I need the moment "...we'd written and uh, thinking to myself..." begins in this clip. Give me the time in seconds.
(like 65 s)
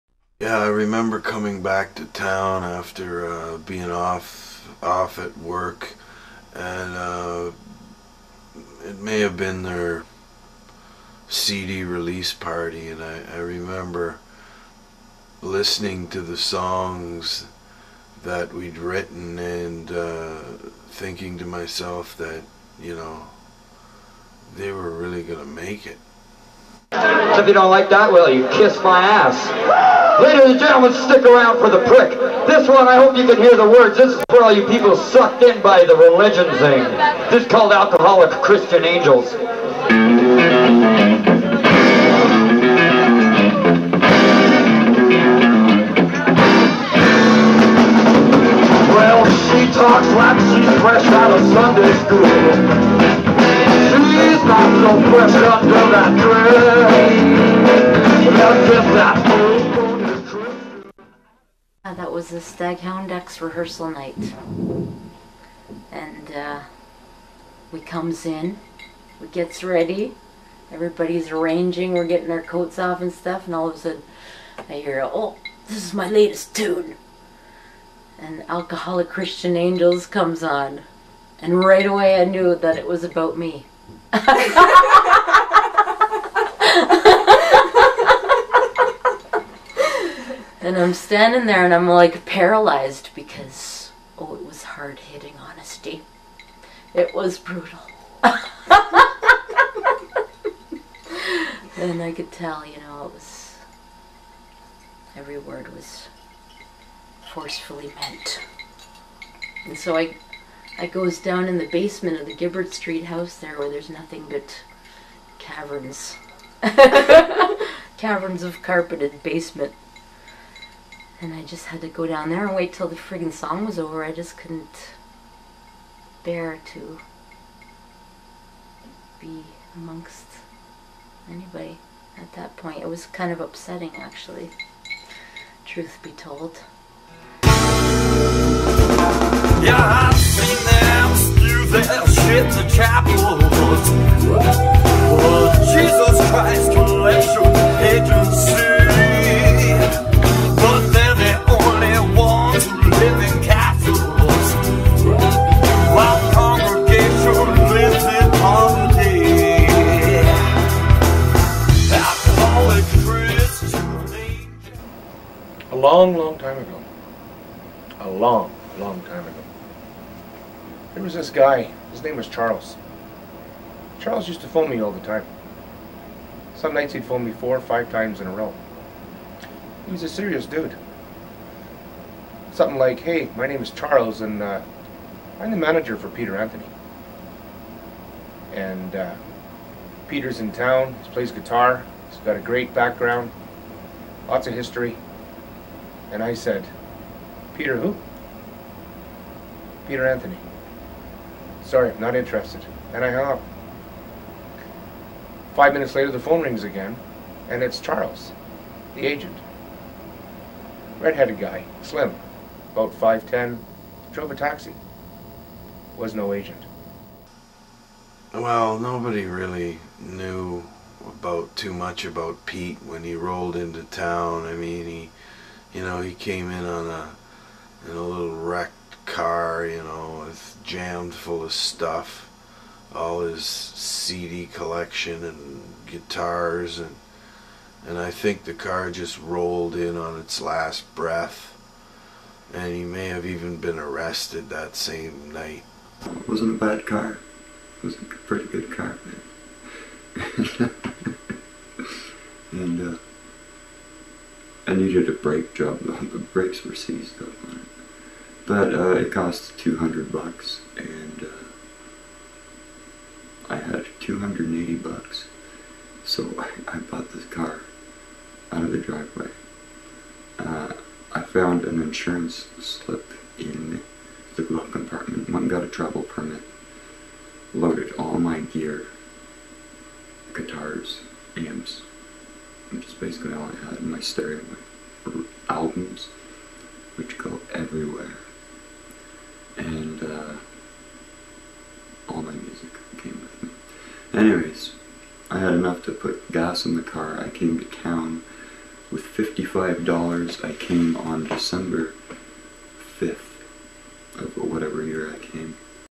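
18 s.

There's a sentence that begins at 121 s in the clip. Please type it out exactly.
And I just had to go down there and wait till the friggin' song was over.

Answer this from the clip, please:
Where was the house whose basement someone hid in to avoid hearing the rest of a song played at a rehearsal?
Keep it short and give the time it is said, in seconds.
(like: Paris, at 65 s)
Gibbard Street, at 112 s.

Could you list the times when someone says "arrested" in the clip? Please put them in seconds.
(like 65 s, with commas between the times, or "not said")
243 s.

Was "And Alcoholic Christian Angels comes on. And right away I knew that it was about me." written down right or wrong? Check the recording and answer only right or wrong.
right.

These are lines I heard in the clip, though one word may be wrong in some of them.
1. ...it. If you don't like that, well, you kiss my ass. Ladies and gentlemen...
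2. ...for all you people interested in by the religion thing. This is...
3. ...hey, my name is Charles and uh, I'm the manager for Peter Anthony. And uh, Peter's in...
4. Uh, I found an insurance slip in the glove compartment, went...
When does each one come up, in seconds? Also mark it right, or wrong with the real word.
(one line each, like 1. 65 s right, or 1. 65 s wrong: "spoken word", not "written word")
1. 25 s right
2. 34 s wrong: "sucked", not "interested"
3. 182 s right
4. 270 s right.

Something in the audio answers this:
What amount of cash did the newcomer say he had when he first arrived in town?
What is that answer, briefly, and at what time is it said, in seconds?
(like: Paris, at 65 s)
$55, at 299 s.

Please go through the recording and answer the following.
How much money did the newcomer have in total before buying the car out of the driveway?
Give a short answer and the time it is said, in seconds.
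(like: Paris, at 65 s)
$280, at 263 s.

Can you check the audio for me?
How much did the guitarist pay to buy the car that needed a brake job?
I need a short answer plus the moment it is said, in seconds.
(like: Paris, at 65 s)
$200, at 259 s.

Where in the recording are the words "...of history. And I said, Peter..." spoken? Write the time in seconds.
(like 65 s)
194 s.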